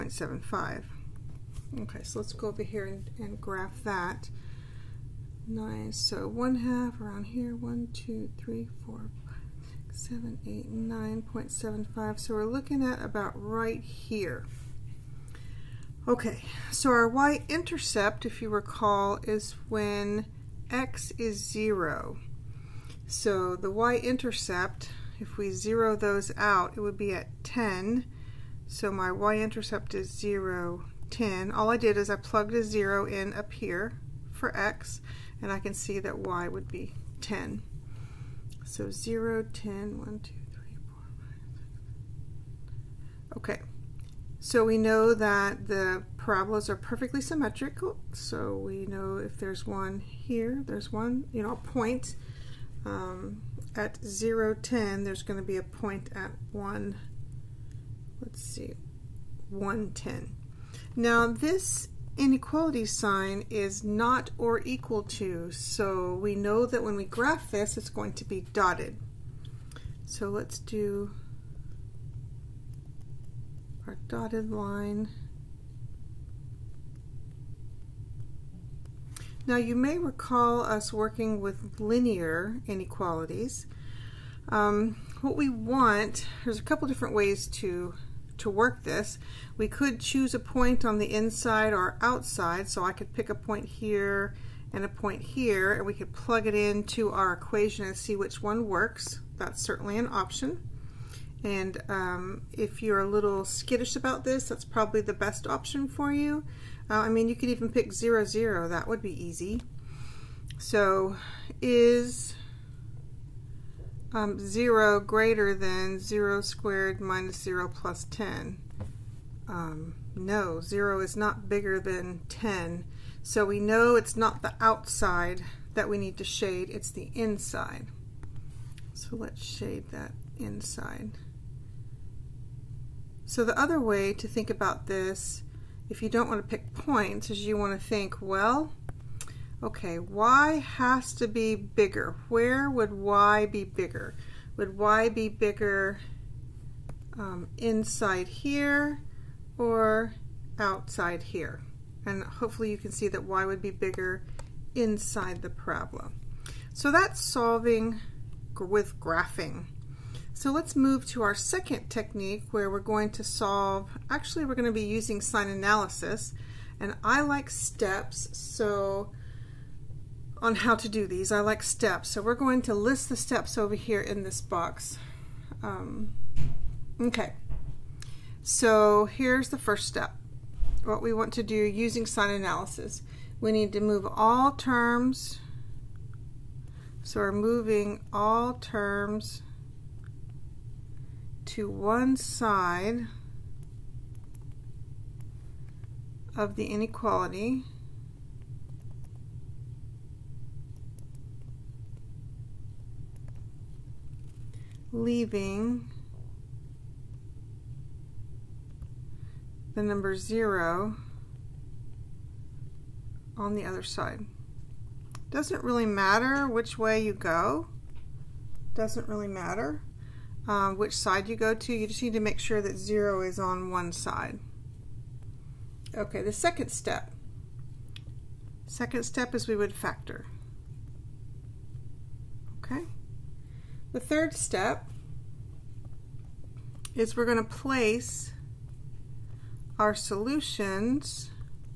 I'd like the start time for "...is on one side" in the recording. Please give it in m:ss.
3:43.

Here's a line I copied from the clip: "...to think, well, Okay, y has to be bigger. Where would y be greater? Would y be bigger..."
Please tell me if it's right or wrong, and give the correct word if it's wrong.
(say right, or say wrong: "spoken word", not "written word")
wrong: "bigger", not "greater".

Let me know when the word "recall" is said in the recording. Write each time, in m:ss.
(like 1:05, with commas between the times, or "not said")
0:18, 1:19.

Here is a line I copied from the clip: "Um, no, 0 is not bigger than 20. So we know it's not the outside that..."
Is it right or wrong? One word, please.
wrong.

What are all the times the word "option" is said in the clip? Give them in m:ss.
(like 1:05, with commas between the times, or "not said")
1:40, 1:45.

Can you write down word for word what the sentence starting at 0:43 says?
Okay, so we know that the parabolas are perfectly symmetrical.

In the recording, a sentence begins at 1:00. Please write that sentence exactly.
Now this inequality sign is not or equal to, so we know that when we graph this, it's going to be dotted.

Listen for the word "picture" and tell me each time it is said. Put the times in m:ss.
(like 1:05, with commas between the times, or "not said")
not said.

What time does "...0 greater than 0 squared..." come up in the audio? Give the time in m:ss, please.
1:54.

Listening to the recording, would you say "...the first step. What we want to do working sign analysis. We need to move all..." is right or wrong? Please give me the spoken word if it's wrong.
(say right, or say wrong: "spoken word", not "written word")
wrong: "using", not "working".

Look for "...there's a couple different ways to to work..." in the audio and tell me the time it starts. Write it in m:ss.
1:26.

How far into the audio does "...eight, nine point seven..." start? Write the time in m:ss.
0:10.